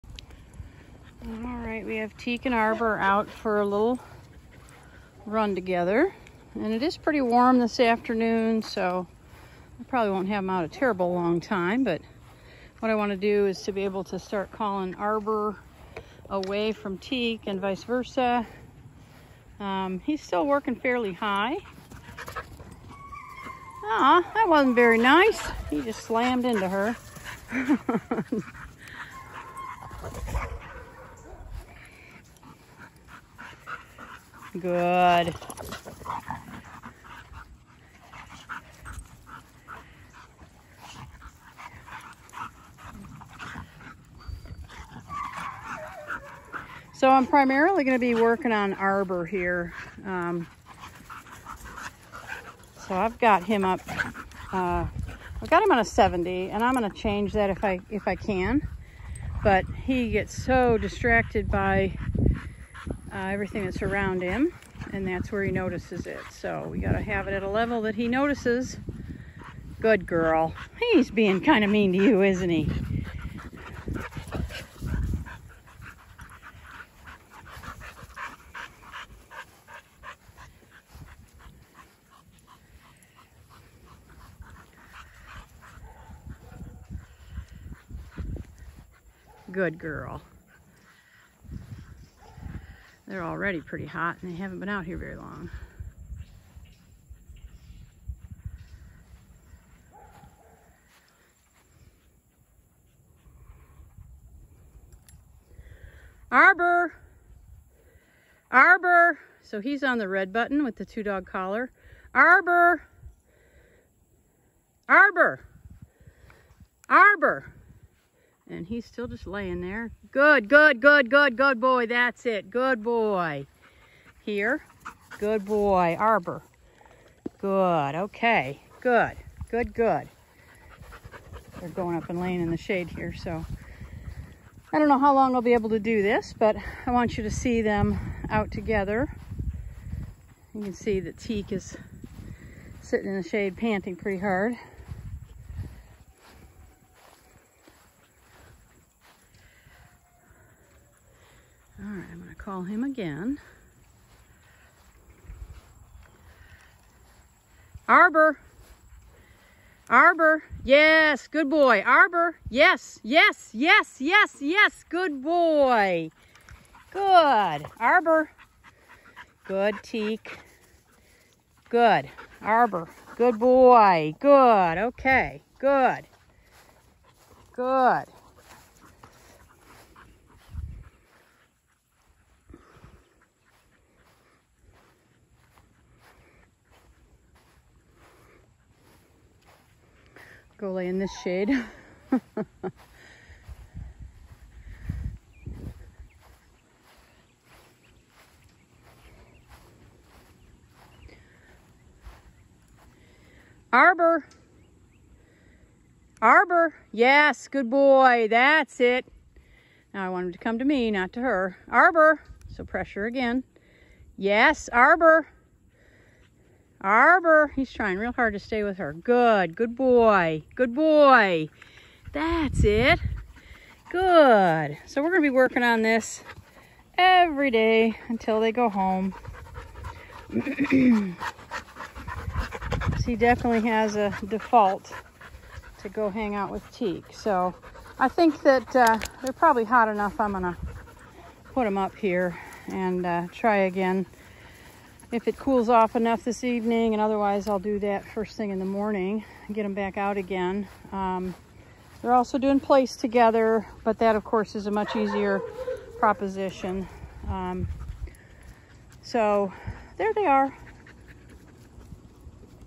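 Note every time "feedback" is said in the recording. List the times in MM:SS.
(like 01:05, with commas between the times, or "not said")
not said.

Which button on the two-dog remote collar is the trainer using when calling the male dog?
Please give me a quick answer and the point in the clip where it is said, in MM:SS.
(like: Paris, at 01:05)
Red, at 01:50.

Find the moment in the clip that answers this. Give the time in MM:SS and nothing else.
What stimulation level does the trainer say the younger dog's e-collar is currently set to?
00:55.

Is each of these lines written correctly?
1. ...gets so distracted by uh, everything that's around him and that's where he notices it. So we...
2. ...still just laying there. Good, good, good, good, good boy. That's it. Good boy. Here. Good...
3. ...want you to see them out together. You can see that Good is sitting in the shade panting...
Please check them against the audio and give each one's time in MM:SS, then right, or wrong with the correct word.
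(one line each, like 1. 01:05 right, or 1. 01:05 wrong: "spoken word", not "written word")
1. 01:00 right
2. 01:58 right
3. 02:16 wrong: "Teak", not "Good".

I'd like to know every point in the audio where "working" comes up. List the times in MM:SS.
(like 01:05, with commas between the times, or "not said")
00:20, 00:48, 03:45.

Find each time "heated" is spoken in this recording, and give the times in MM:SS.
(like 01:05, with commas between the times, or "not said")
not said.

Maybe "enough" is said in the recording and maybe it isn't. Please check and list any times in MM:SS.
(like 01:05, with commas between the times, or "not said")
03:59, 04:05.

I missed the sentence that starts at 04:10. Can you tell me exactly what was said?
Um, they're also doing place together, but that of course is a much easier proposition.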